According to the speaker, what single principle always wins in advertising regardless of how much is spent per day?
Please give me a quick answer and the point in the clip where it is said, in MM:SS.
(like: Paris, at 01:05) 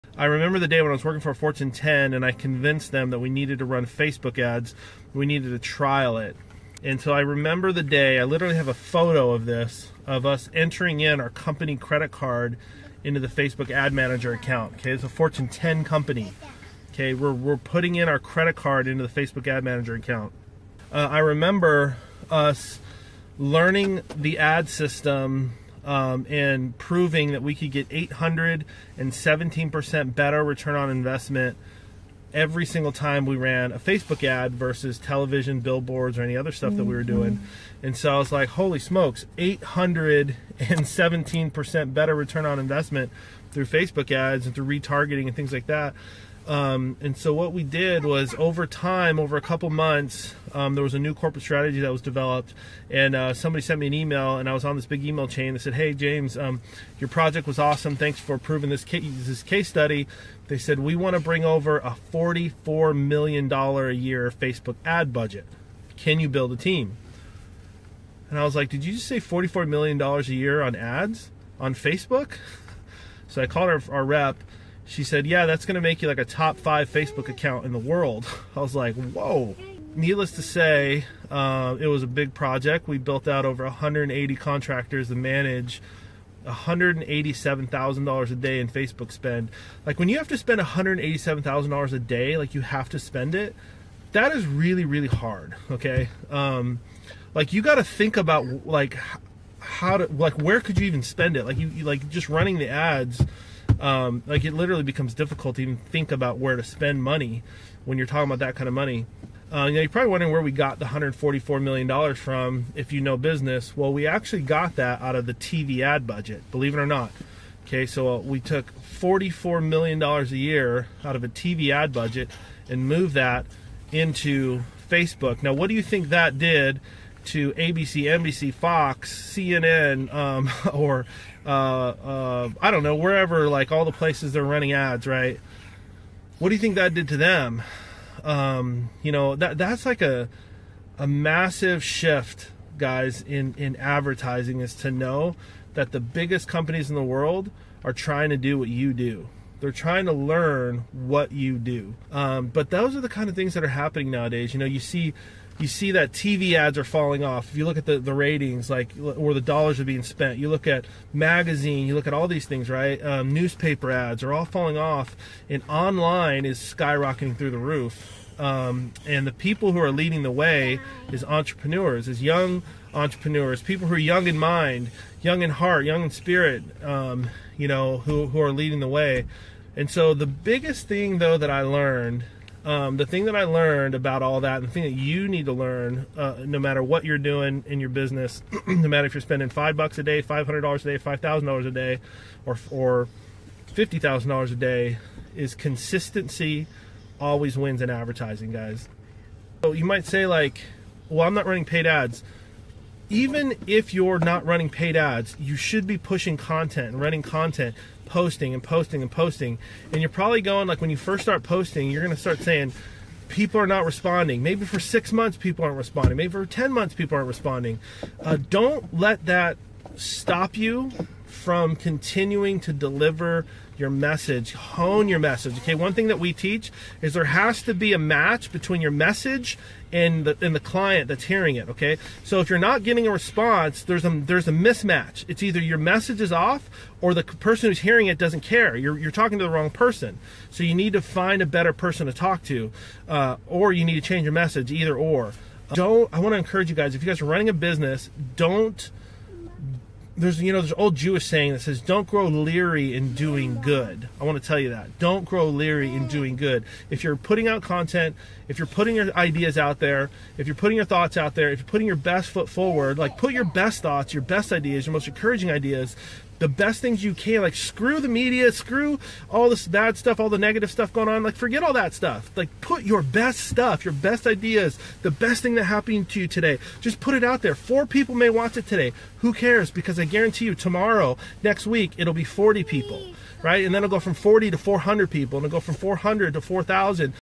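Consistency, at 03:15.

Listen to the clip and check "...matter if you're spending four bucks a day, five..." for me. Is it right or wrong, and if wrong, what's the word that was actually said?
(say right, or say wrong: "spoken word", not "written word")
wrong: "five", not "four".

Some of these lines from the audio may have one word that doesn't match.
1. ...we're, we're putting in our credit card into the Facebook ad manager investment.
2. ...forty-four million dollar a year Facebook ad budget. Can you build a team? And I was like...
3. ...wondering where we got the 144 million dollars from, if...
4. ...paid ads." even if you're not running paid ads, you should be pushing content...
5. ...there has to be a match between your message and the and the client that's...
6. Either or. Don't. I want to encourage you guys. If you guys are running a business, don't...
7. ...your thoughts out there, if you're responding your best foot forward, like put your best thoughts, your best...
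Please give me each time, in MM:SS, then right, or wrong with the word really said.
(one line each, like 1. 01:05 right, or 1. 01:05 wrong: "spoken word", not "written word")
1. 00:17 wrong: "account", not "investment"
2. 01:02 right
3. 01:50 right
4. 03:21 right
5. 03:47 right
6. 04:04 right
7. 04:20 wrong: "putting", not "responding".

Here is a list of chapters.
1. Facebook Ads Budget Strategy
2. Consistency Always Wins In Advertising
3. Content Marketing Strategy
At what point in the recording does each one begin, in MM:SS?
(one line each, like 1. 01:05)
1. 00:56
2. 03:00
3. 03:19.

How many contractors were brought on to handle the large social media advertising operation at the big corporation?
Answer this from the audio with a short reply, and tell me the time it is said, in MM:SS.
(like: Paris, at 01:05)
180, at 01:23.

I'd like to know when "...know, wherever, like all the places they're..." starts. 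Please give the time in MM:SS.
02:12.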